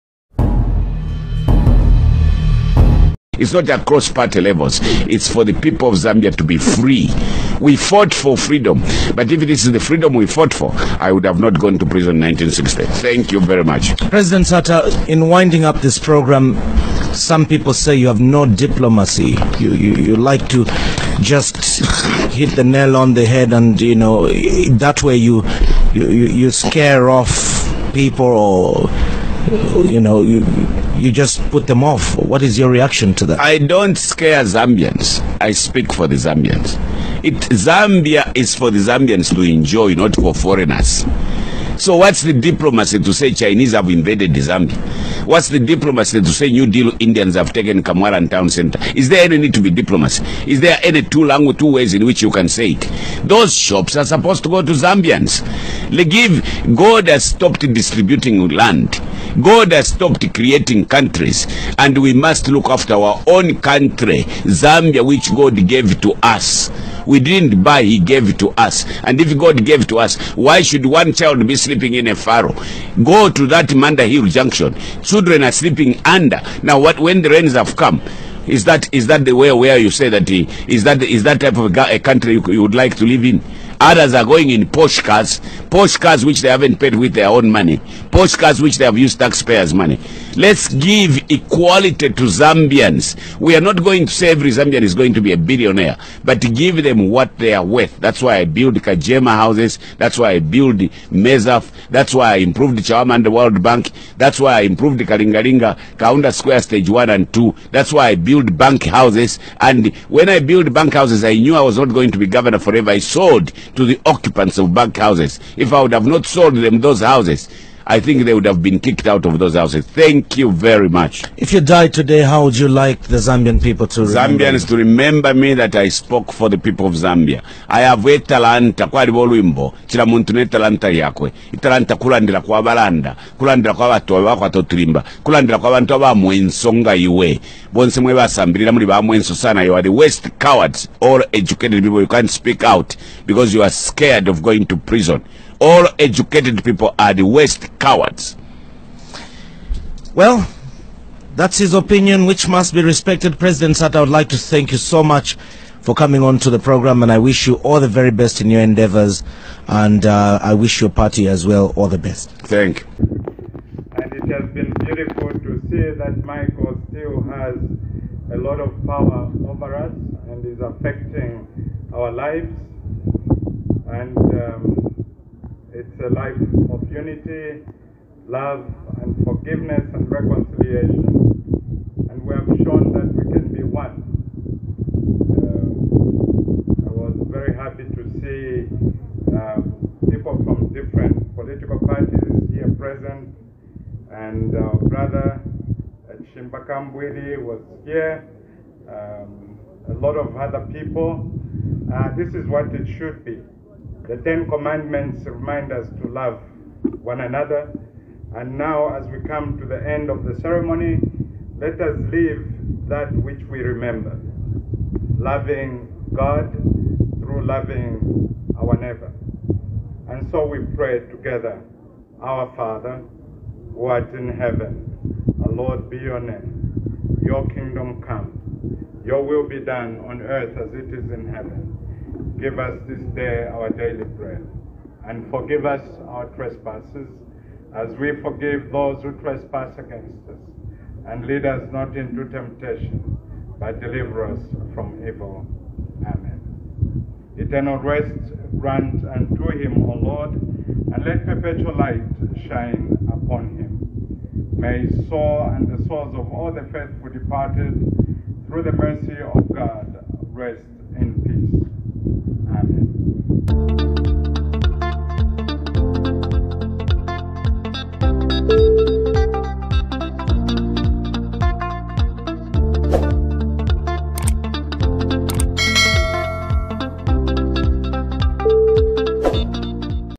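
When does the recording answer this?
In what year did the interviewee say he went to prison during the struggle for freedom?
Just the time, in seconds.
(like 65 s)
12 s.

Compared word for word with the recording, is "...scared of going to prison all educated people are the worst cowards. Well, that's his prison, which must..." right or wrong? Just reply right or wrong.
wrong.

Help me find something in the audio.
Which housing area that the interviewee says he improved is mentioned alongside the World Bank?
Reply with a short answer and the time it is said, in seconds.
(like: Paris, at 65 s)
Chawama, at 102 s.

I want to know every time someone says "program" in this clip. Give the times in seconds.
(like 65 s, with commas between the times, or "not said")
15 s, 156 s.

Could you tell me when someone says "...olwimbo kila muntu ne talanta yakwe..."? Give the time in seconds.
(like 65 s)
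129 s.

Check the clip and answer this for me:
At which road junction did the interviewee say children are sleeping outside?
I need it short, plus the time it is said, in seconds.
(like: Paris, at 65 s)
Manda Hill Junction, at 73 s.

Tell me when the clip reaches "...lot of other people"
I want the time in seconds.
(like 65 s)
199 s.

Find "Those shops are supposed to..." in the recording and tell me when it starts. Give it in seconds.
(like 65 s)
53 s.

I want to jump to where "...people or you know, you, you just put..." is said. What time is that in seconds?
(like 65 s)
27 s.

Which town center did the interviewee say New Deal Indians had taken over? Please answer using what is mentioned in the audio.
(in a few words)
Kamwala.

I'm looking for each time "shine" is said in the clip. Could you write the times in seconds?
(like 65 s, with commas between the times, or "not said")
252 s.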